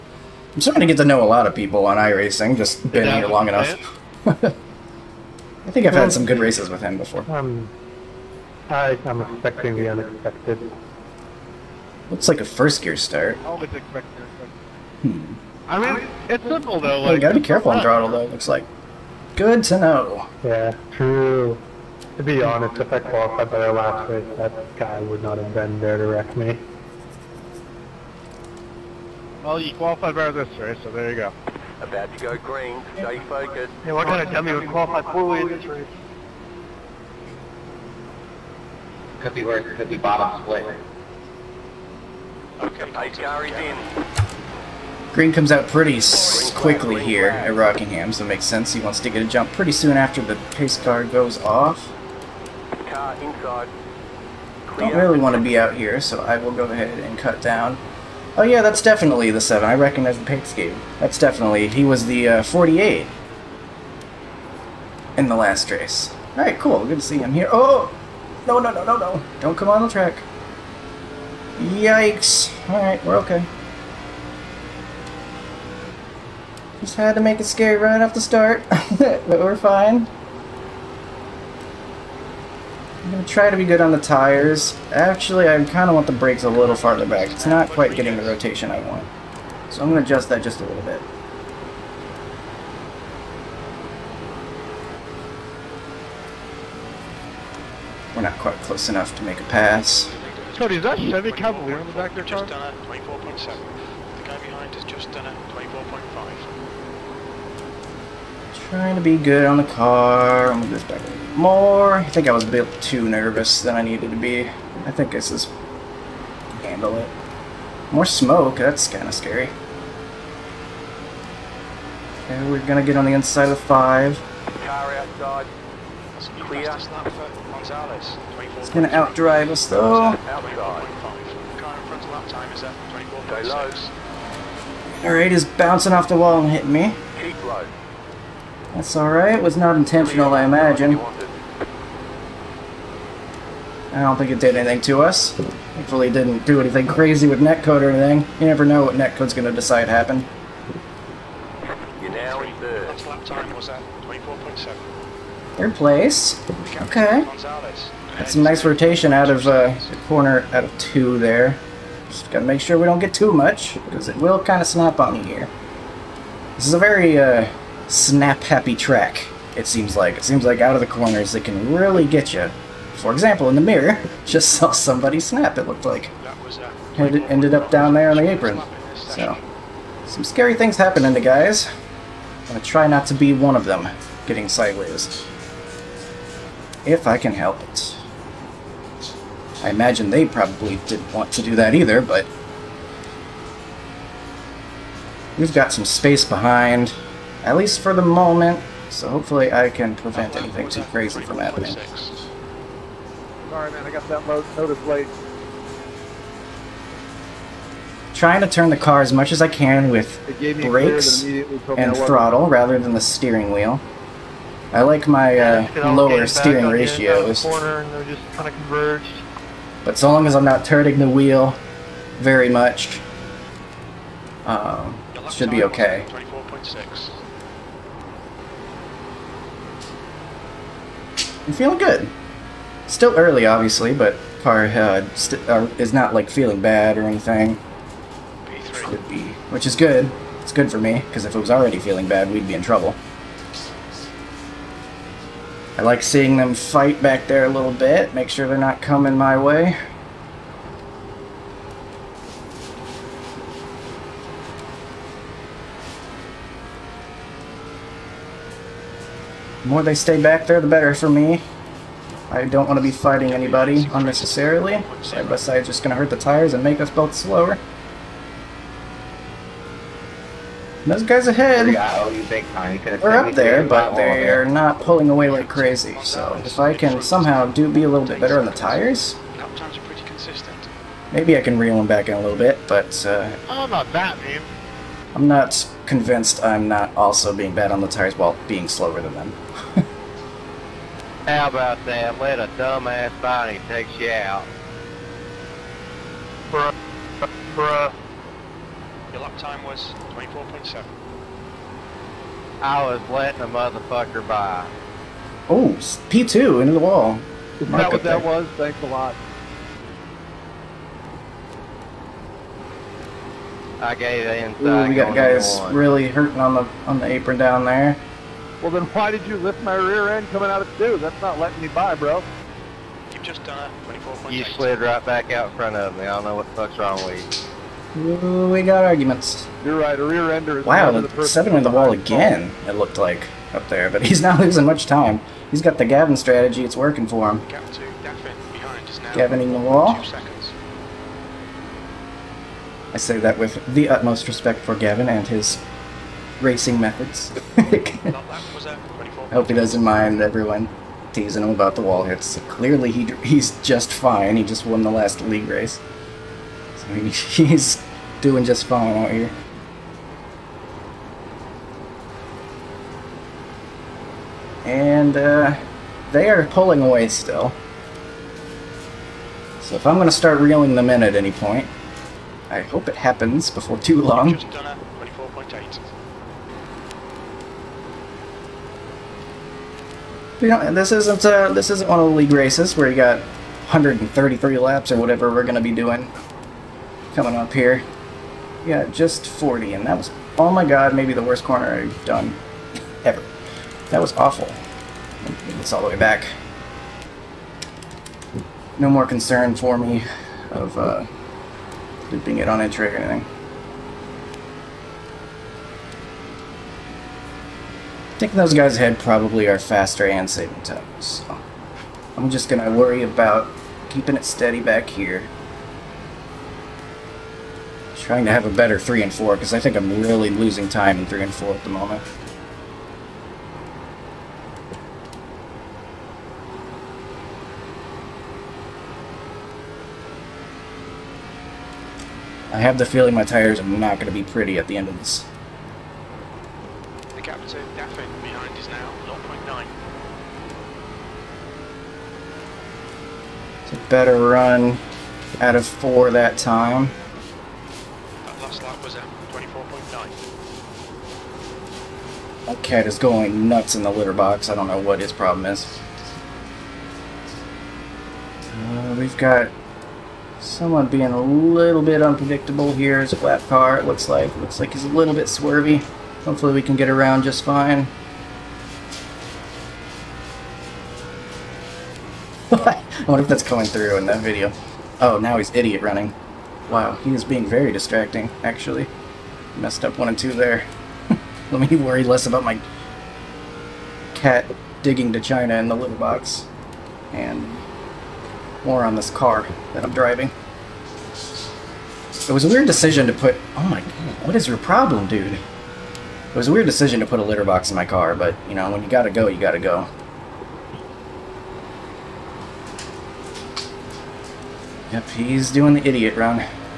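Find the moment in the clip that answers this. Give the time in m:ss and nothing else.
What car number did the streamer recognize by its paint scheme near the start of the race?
0:59.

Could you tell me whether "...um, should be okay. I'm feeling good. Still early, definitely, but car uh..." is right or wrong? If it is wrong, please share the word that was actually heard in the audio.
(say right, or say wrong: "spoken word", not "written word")
wrong: "obviously", not "definitely".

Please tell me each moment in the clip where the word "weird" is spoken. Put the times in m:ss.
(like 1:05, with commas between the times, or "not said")
8:12, 8:16.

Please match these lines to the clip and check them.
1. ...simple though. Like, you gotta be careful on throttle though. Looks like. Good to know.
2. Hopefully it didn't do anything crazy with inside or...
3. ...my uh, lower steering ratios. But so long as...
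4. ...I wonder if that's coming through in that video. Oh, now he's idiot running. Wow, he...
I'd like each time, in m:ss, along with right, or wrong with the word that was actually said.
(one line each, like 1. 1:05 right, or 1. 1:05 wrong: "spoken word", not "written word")
1. 0:16 right
2. 2:25 wrong: "netcode", not "inside"
3. 3:35 right
4. 7:52 right.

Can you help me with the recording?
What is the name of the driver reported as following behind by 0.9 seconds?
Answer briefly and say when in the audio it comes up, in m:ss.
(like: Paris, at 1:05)
Daffin, at 7:17.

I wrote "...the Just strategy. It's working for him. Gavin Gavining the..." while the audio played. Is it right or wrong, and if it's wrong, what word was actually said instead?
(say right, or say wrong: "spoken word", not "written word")
wrong: "Gavin", not "Just".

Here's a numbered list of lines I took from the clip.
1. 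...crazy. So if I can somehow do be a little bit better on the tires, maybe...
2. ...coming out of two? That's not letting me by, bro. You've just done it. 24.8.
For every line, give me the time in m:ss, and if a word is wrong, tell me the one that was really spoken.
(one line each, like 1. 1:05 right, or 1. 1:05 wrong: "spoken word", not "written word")
1. 4:35 right
2. 5:20 right.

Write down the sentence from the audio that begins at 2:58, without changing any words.
So, some scary things happening to guys.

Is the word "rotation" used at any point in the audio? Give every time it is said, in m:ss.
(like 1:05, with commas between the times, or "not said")
1:28, 2:38.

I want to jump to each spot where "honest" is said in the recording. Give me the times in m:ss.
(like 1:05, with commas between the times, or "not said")
0:22.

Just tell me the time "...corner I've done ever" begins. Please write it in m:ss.
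6:31.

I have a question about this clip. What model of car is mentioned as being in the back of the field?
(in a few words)
Chevy Cavalier.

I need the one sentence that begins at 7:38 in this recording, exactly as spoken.
Uh, we've got someone being a little bit unpredictable here.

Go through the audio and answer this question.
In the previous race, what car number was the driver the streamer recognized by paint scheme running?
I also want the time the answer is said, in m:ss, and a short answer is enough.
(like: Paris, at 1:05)
48, at 1:02.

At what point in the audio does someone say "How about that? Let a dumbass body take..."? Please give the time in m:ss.
4:51.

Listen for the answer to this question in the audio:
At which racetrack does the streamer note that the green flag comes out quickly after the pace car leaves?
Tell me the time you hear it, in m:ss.
0:47.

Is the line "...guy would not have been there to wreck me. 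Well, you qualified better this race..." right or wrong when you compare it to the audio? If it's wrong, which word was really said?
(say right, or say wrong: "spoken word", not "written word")
right.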